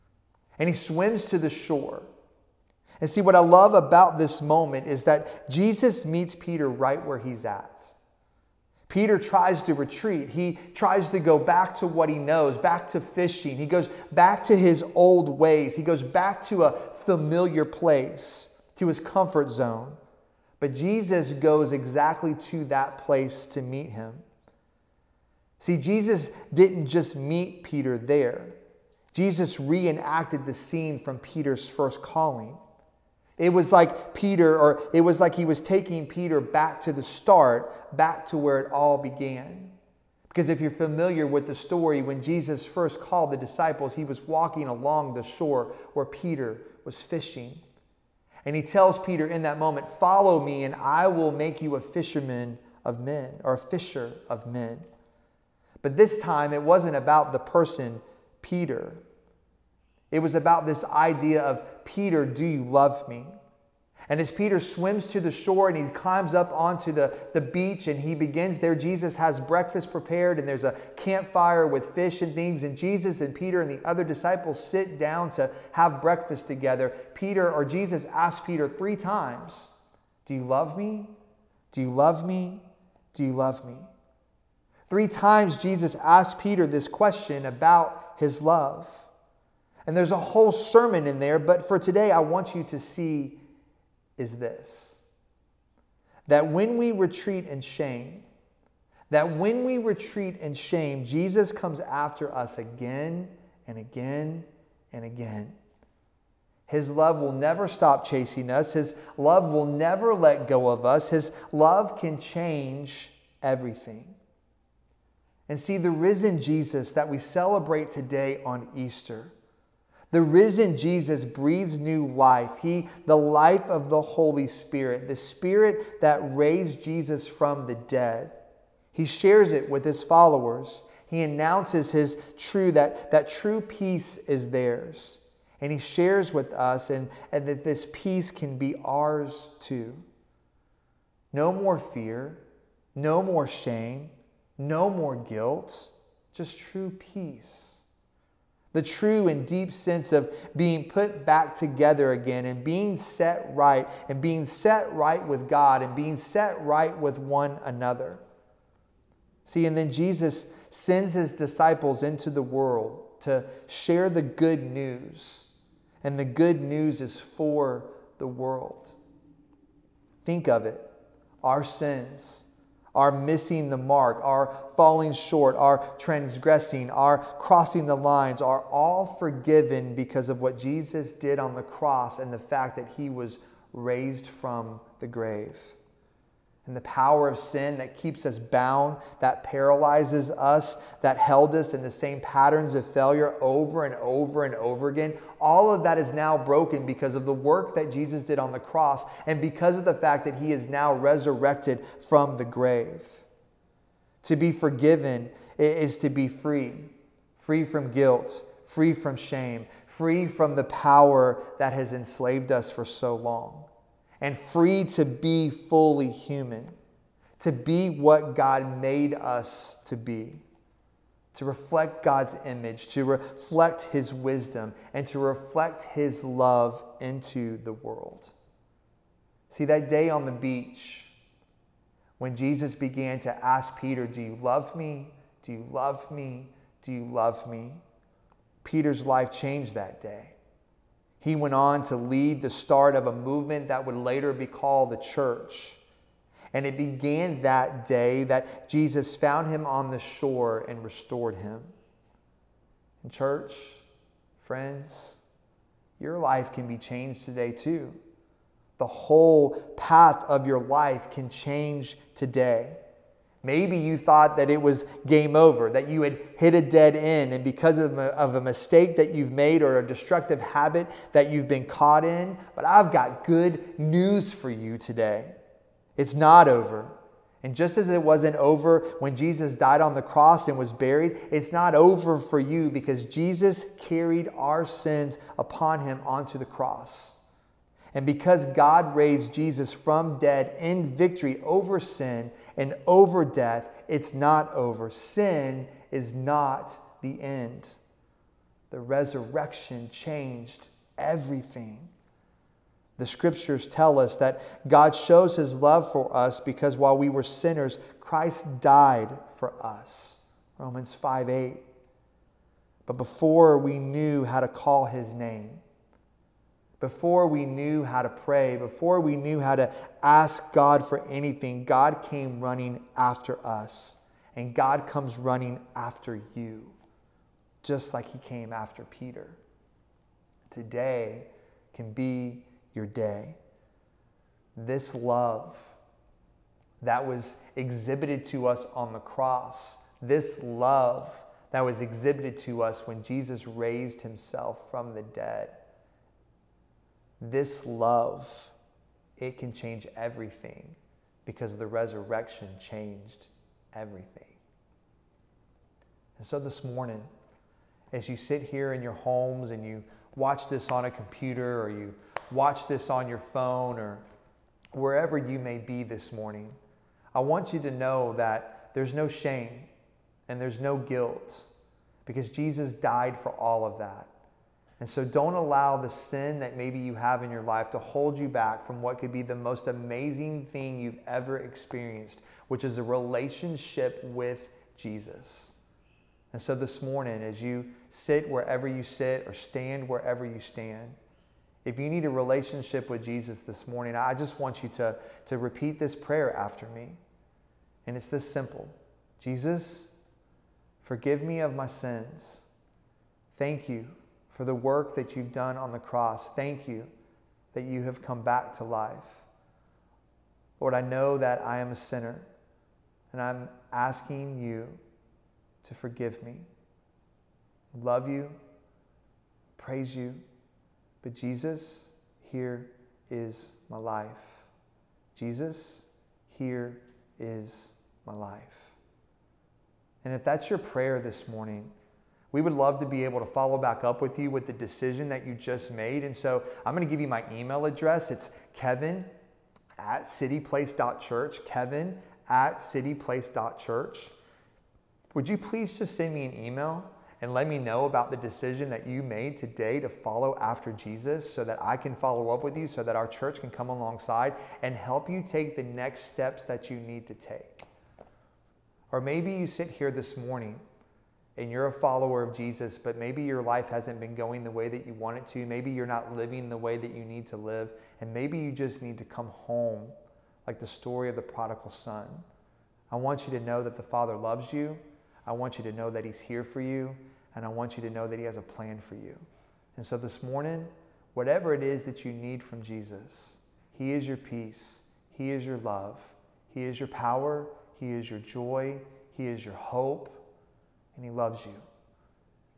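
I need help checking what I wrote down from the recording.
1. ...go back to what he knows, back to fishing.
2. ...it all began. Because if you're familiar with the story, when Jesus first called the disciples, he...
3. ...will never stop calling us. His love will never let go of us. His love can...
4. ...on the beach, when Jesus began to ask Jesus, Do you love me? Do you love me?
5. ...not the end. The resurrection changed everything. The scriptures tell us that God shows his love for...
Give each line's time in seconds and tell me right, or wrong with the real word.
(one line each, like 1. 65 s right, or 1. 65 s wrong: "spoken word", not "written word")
1. 11 s right
2. 38 s right
3. 107 s wrong: "chasing", not "calling"
4. 230 s wrong: "Peter", not "Jesus"
5. 296 s right.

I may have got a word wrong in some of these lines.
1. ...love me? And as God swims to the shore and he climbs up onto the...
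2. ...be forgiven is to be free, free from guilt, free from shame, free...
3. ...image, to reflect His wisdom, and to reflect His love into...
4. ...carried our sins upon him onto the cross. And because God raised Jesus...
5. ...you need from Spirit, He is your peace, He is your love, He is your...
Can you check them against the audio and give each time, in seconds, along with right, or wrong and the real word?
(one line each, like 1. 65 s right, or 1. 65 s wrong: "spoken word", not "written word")
1. 62 s wrong: "Peter", not "God"
2. 204 s right
3. 222 s right
4. 283 s right
5. 482 s wrong: "Jesus", not "Spirit".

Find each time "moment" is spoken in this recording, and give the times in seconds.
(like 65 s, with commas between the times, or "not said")
4 s, 49 s.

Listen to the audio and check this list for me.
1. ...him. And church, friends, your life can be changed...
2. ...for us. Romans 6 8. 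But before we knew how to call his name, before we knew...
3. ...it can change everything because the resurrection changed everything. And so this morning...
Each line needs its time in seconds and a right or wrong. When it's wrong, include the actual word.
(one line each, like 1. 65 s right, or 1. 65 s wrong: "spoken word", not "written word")
1. 251 s right
2. 309 s wrong: "5", not "6"
3. 349 s right.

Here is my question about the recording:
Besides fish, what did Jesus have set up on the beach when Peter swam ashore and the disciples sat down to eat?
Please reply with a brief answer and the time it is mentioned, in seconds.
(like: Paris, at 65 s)
A campfire, at 70 s.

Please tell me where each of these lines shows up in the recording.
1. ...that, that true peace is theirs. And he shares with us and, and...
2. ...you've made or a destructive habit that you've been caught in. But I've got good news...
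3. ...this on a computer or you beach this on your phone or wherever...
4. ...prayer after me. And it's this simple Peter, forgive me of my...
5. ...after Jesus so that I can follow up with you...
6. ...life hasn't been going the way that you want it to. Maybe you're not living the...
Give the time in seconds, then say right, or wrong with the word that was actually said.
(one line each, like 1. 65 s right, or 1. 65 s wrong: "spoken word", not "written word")
1. 132 s right
2. 269 s right
3. 360 s wrong: "watch", not "beach"
4. 395 s wrong: "Jesus", not "Peter"
5. 450 s right
6. 463 s right.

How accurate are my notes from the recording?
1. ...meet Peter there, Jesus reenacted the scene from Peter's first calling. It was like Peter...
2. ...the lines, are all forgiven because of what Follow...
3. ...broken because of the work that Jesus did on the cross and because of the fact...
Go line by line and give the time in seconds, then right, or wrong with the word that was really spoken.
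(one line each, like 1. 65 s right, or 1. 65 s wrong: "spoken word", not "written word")
1. 27 s right
2. 177 s wrong: "Jesus", not "Follow"
3. 196 s right.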